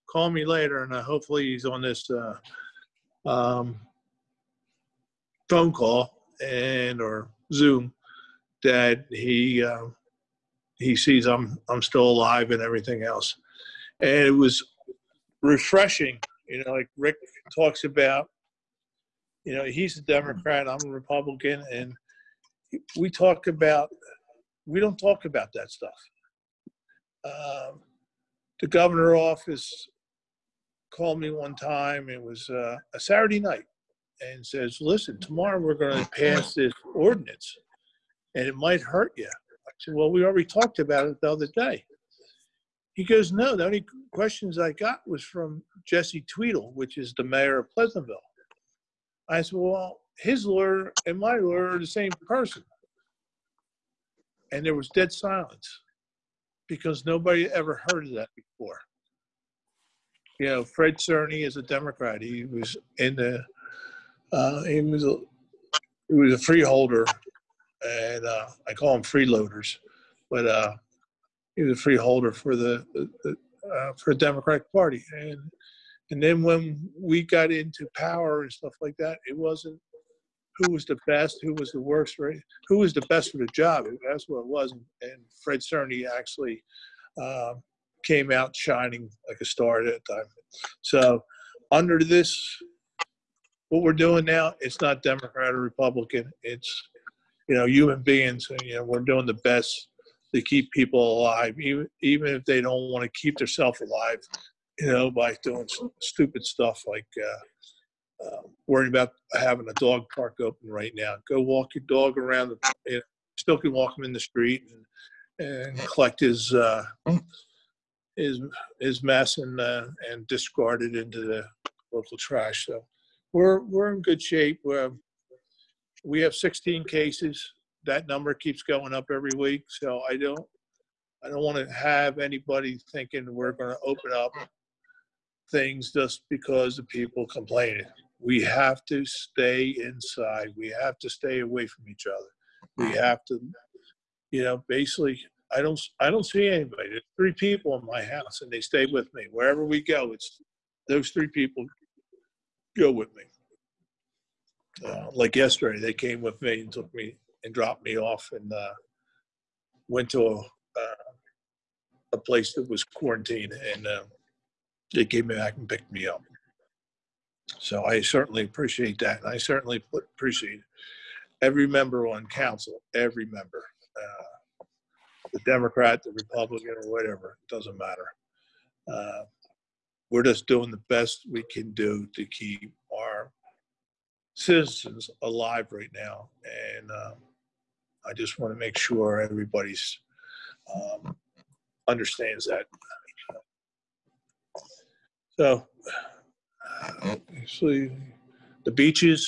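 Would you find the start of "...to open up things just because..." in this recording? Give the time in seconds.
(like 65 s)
133 s.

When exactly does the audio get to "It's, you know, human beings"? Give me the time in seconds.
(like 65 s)
96 s.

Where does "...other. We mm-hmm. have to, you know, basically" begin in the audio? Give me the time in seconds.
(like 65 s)
142 s.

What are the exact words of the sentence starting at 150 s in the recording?
It's those three people go with me.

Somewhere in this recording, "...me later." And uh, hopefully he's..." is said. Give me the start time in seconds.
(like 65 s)
0 s.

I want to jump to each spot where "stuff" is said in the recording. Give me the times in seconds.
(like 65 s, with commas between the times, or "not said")
25 s, 78 s, 106 s.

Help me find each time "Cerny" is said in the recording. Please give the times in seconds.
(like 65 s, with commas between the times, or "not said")
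60 s, 85 s.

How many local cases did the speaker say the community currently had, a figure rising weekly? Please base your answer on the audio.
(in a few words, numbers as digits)
16.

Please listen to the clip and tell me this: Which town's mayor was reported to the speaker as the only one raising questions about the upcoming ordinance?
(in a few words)
Pleasantville.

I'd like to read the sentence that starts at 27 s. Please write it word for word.
Um, the governor office called me one time.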